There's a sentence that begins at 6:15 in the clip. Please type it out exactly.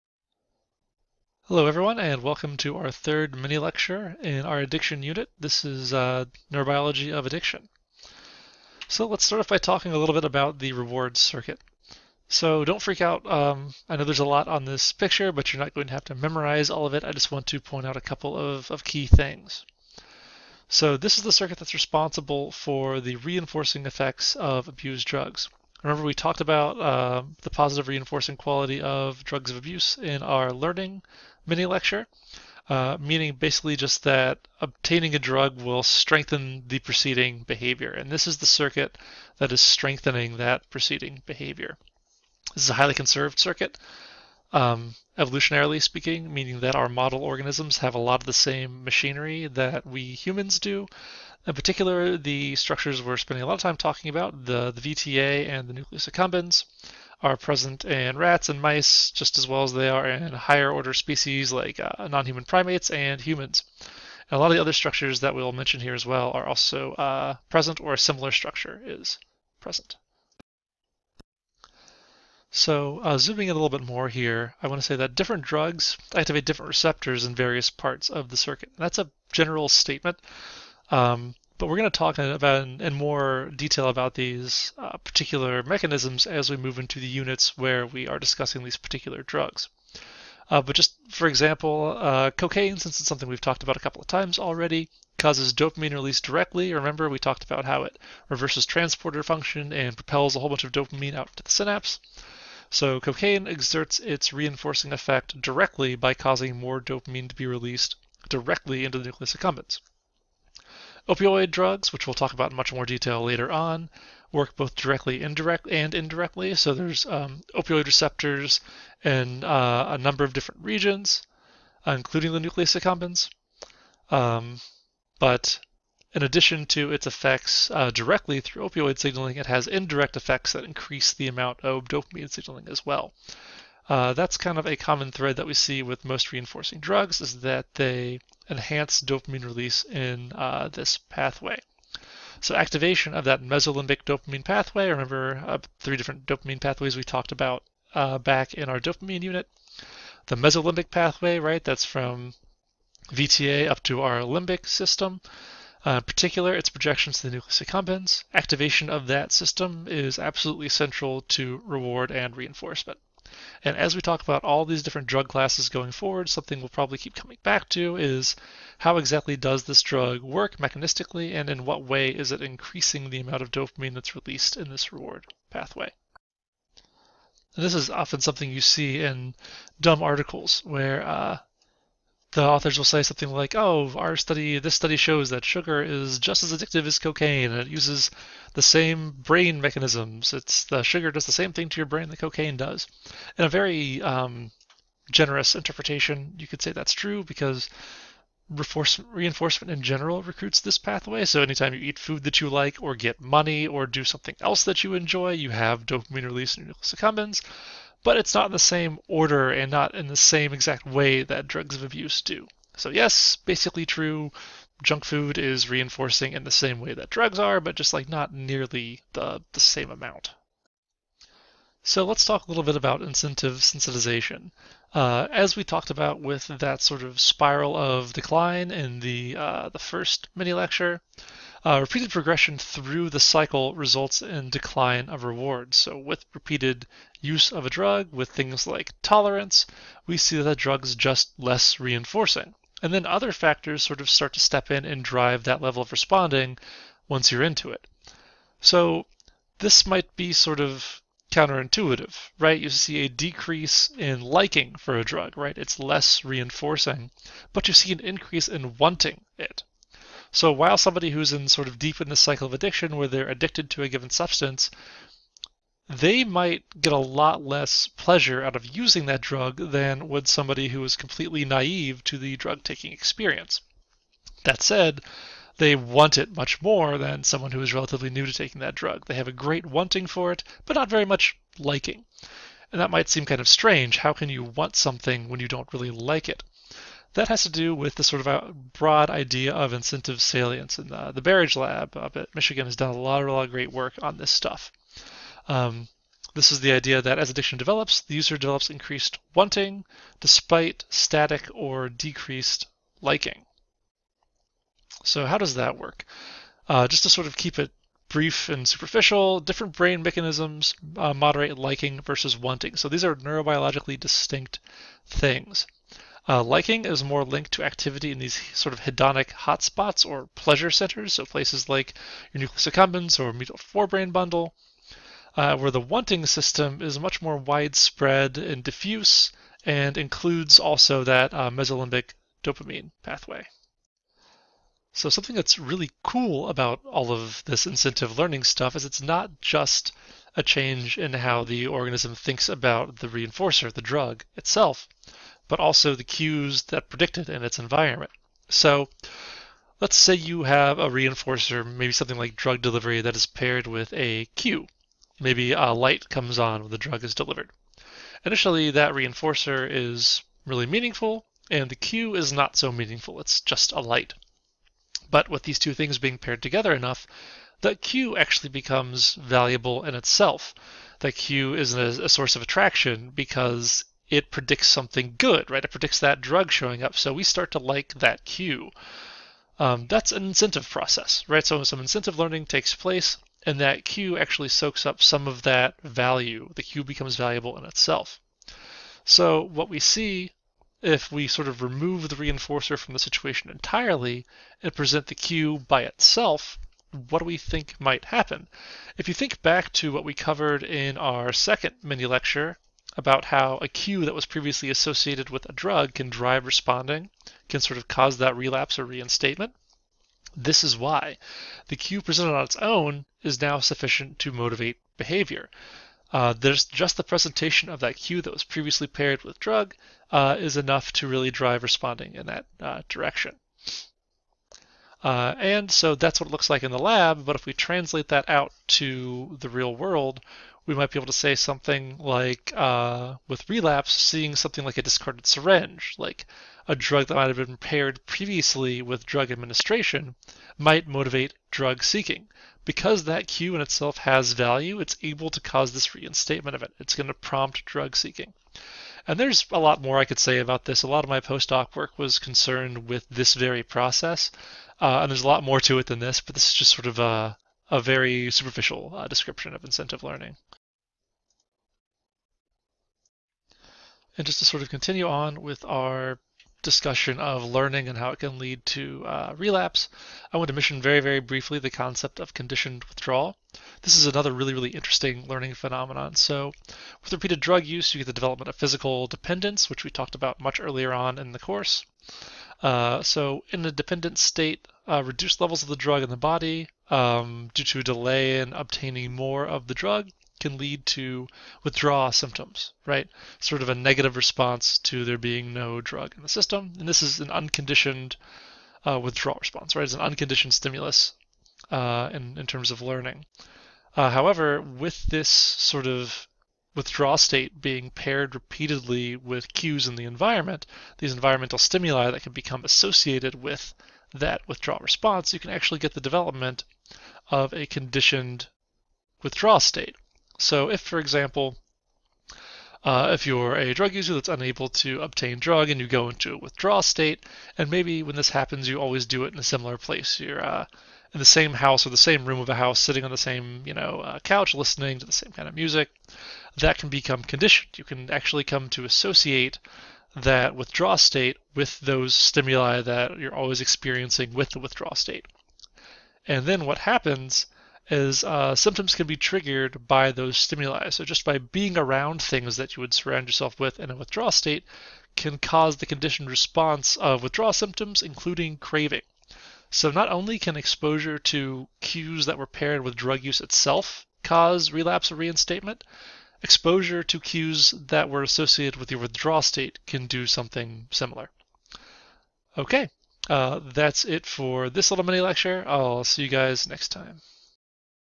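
It predicts that drug showing up.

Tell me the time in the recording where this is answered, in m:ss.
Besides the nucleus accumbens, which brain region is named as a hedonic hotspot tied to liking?
5:23.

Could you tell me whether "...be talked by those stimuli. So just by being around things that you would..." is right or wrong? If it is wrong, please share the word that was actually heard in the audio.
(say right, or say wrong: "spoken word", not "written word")
wrong: "triggered", not "talked".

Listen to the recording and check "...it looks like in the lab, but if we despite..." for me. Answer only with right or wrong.
wrong.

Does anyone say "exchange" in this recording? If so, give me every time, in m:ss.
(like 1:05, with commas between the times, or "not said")
not said.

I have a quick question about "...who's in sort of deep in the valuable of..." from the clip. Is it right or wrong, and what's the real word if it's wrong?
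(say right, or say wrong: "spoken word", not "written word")
wrong: "cycle", not "valuable".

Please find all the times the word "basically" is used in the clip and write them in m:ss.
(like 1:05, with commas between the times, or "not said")
0:33, 3:33.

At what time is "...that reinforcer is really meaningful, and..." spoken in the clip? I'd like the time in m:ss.
5:58.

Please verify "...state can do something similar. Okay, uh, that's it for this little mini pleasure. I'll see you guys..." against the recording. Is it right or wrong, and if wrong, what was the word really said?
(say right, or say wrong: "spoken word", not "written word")
wrong: "lecture", not "pleasure".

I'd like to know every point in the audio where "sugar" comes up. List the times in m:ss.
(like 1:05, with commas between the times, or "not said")
3:05, 3:10.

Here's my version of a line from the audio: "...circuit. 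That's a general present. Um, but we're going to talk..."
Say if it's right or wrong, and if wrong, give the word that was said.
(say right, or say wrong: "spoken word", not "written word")
wrong: "statement", not "present".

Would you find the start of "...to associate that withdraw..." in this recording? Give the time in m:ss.
8:58.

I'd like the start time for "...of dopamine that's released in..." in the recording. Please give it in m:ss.
2:53.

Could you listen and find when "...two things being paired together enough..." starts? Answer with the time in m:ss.
6:05.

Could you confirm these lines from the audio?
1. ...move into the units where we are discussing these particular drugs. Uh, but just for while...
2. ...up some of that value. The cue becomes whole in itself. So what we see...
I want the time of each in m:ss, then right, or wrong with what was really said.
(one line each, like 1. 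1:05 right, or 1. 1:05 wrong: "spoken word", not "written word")
1. 1:26 wrong: "example", not "while"
2. 6:24 wrong: "valuable", not "whole".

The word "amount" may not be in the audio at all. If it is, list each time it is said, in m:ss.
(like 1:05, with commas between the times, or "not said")
2:11, 2:53, 3:39.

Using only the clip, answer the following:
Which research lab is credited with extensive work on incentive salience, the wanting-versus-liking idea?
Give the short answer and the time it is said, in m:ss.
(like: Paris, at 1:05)
Berridge Lab, at 4:51.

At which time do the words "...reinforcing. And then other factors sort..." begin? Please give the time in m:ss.
4:01.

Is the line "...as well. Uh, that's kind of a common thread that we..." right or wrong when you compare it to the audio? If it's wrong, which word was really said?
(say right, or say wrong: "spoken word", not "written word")
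right.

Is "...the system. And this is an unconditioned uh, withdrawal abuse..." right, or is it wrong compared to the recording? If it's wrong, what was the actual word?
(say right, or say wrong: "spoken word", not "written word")
wrong: "response", not "abuse".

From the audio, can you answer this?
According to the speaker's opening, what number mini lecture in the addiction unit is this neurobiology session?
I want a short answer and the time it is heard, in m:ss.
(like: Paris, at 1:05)
third, at 0:02.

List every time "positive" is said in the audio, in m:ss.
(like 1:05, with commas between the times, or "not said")
0:27.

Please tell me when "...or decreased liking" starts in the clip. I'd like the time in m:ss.
5:01.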